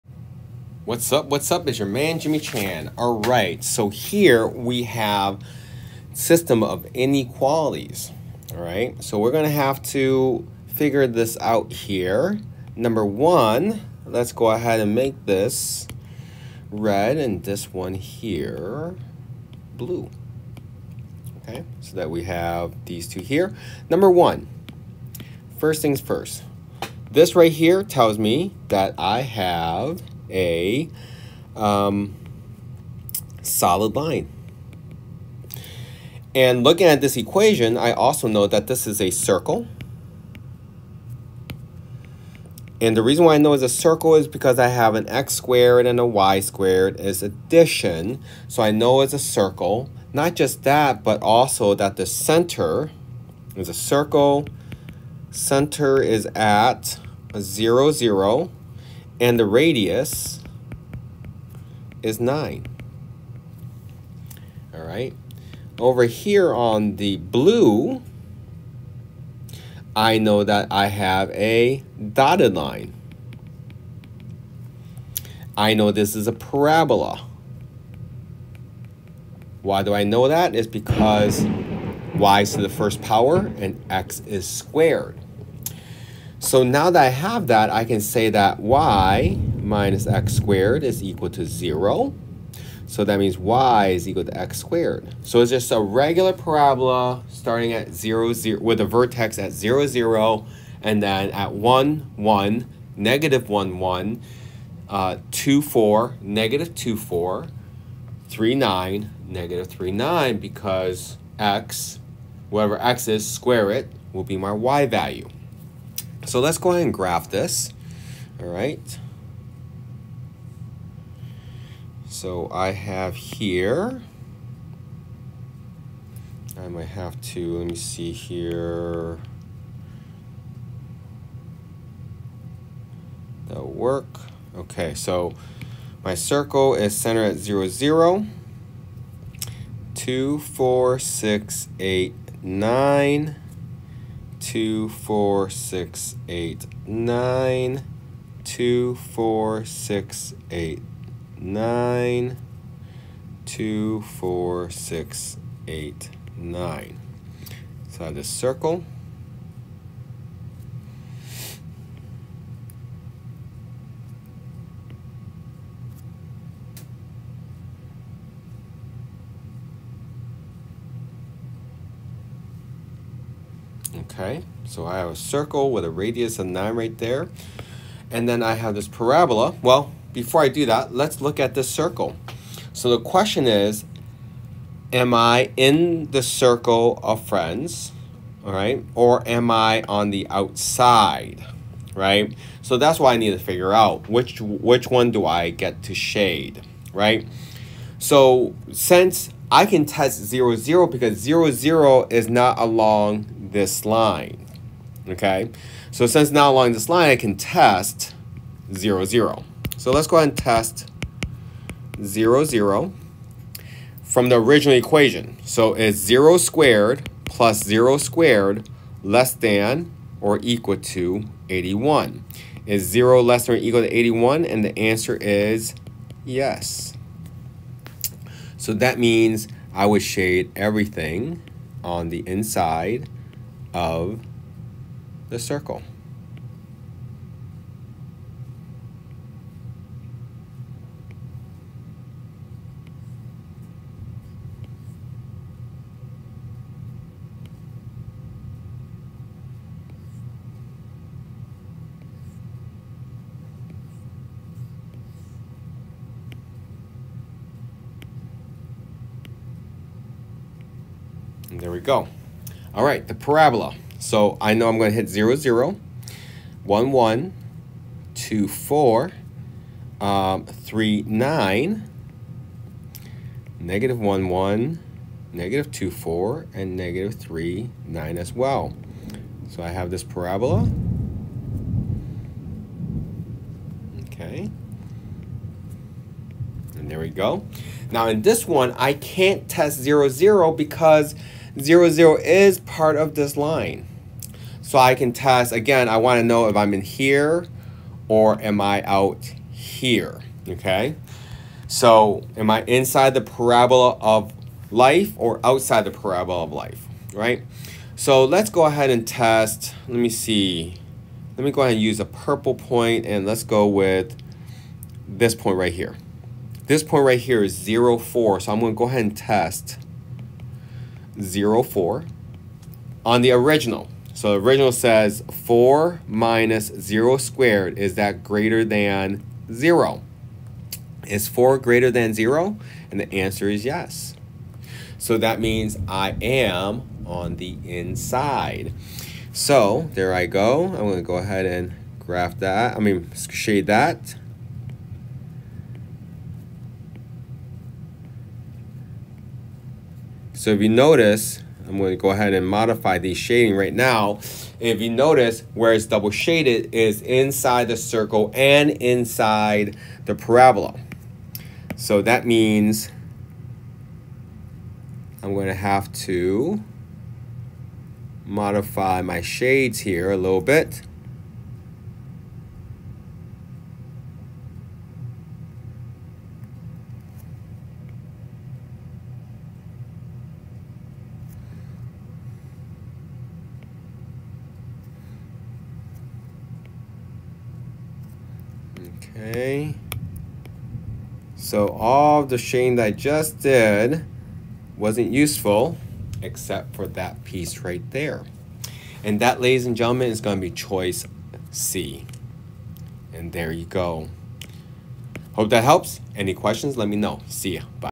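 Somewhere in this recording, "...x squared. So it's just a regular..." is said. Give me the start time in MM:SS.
01:34.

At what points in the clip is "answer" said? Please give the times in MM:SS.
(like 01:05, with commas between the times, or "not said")
03:44, 05:33.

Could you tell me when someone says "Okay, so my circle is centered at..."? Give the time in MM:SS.
02:14.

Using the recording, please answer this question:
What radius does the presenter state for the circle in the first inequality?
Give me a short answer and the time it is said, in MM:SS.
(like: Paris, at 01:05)
9, at 01:02.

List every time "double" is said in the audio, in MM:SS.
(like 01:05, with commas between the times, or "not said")
05:55.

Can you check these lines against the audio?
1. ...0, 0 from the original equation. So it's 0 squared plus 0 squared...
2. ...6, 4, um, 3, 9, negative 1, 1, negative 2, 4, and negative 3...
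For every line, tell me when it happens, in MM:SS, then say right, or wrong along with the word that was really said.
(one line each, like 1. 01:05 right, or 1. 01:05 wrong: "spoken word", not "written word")
1. 03:32 right
2. 04:28 wrong: "2", not "6".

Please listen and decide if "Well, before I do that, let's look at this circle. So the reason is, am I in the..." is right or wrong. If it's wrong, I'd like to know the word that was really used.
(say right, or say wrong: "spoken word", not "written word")
wrong: "question", not "reason".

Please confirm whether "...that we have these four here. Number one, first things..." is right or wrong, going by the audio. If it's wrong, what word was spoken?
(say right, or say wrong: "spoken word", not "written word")
wrong: "two", not "four".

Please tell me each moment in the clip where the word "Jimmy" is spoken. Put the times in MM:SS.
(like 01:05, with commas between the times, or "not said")
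00:02.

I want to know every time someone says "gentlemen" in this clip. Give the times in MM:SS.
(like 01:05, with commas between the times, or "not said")
06:39.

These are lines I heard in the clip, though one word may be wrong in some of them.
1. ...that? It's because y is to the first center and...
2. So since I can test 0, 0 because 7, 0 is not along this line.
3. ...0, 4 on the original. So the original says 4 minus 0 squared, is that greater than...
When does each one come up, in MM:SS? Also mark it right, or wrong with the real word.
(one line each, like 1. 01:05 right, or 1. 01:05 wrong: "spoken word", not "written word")
1. 01:20 wrong: "power", not "center"
2. 03:17 wrong: "0", not "7"
3. 05:21 right.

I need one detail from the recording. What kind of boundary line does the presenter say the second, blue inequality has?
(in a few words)
Dotted line.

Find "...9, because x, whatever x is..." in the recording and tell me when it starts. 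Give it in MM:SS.
01:49.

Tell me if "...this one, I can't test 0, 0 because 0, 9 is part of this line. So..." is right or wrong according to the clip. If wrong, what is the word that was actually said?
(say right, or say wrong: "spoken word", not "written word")
wrong: "0", not "9".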